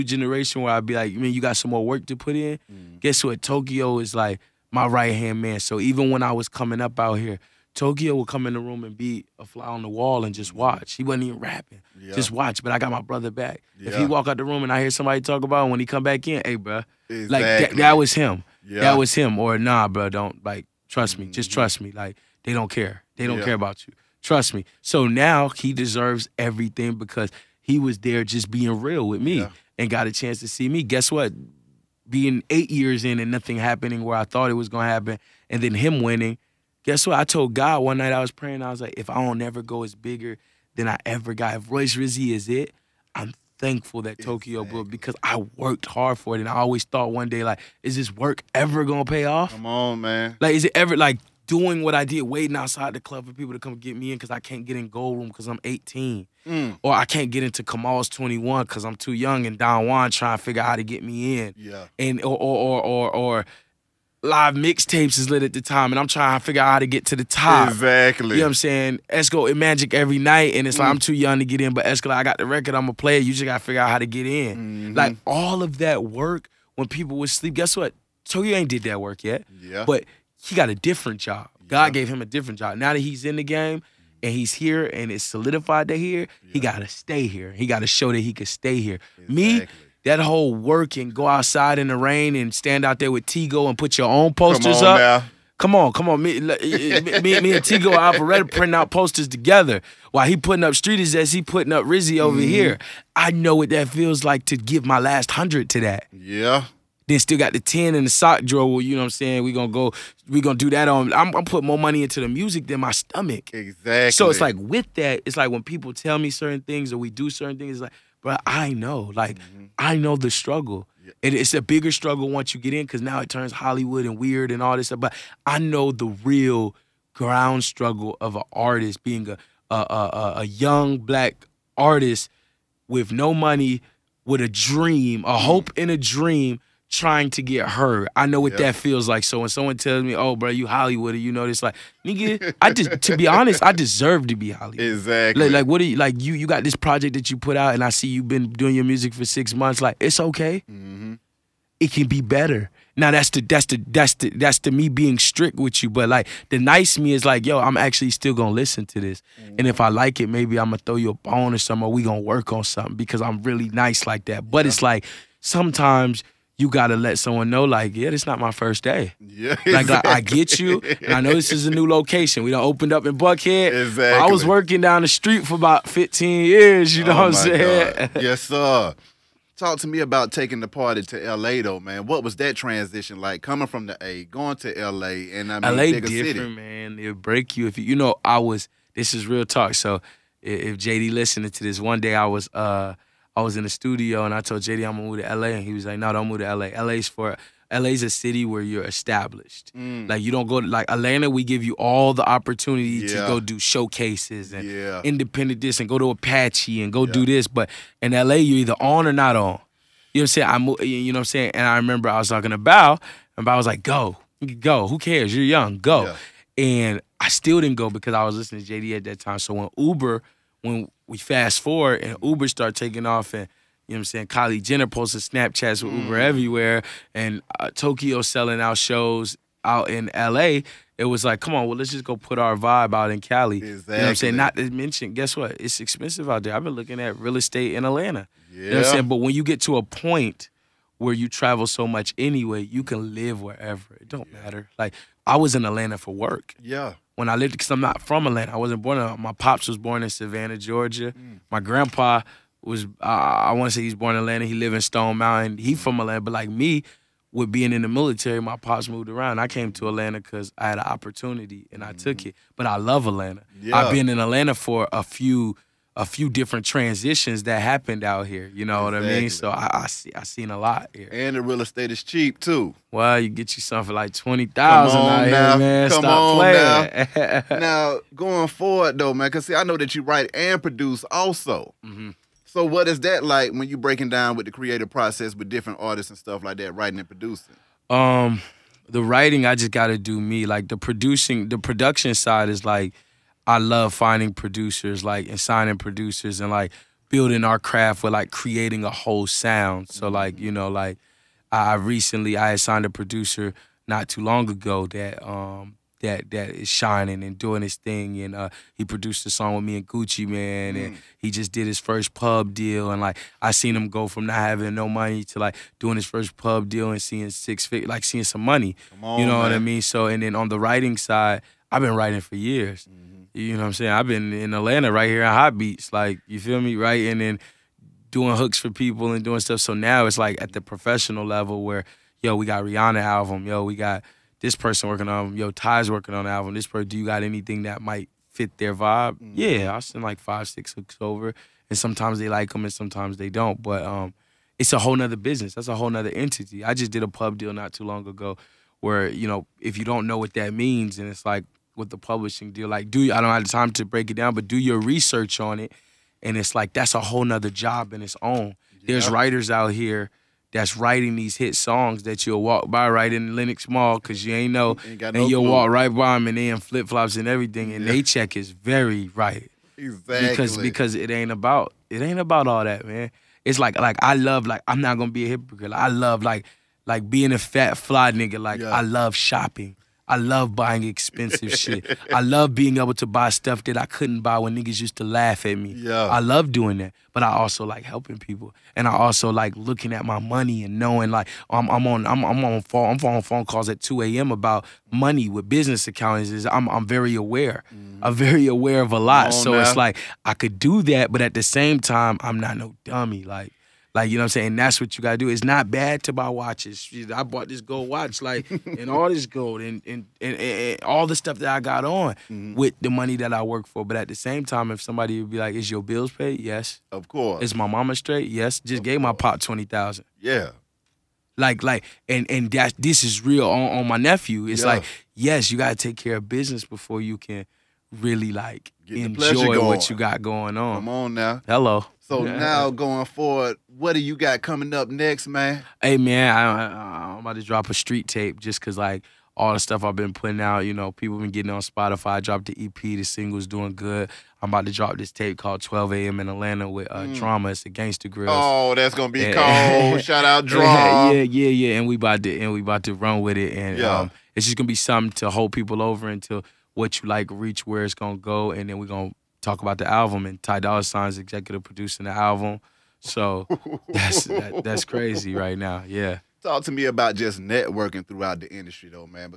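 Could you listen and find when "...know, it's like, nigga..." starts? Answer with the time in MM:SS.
02:21.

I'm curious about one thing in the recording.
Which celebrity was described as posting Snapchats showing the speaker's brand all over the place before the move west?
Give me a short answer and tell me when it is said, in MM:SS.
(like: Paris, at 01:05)
Kylie Jenner, at 03:44.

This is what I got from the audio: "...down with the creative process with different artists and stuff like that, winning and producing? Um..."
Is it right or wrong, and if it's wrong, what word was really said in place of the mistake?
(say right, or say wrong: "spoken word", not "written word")
wrong: "writing", not "winning".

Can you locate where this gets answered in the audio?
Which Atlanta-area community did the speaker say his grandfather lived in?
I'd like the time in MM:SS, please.
04:14.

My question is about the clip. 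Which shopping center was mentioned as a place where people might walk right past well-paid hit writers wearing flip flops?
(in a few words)
Lenox Mall.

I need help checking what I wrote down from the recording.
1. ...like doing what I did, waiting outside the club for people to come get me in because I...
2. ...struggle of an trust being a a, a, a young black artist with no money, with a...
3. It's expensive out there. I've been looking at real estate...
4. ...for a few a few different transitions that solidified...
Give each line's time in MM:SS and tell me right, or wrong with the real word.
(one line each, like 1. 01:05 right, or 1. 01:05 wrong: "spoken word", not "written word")
1. 00:50 right
2. 02:07 wrong: "artist", not "trust"
3. 03:55 right
4. 04:24 wrong: "happened", not "solidified".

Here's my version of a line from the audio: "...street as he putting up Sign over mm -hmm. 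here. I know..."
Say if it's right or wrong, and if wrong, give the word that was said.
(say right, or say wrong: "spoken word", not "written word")
wrong: "Rizzy", not "Sign".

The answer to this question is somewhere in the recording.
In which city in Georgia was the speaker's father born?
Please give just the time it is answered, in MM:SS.
04:10.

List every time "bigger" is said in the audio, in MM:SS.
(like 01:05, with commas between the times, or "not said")
00:39, 02:01.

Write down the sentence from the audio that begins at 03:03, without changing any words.
Coming from the A, going to LA, and I mean, LA different, city.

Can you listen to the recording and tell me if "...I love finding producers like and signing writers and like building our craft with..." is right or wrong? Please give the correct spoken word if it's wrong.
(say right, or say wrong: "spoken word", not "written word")
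wrong: "producers", not "writers".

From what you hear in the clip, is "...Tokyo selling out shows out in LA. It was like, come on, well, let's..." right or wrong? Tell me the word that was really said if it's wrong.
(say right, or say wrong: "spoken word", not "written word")
right.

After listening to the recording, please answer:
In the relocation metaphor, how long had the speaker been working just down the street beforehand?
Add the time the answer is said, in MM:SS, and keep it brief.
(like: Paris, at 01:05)
15 years, at 02:55.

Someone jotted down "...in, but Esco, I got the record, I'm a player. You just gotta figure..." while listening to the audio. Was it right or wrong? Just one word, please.
right.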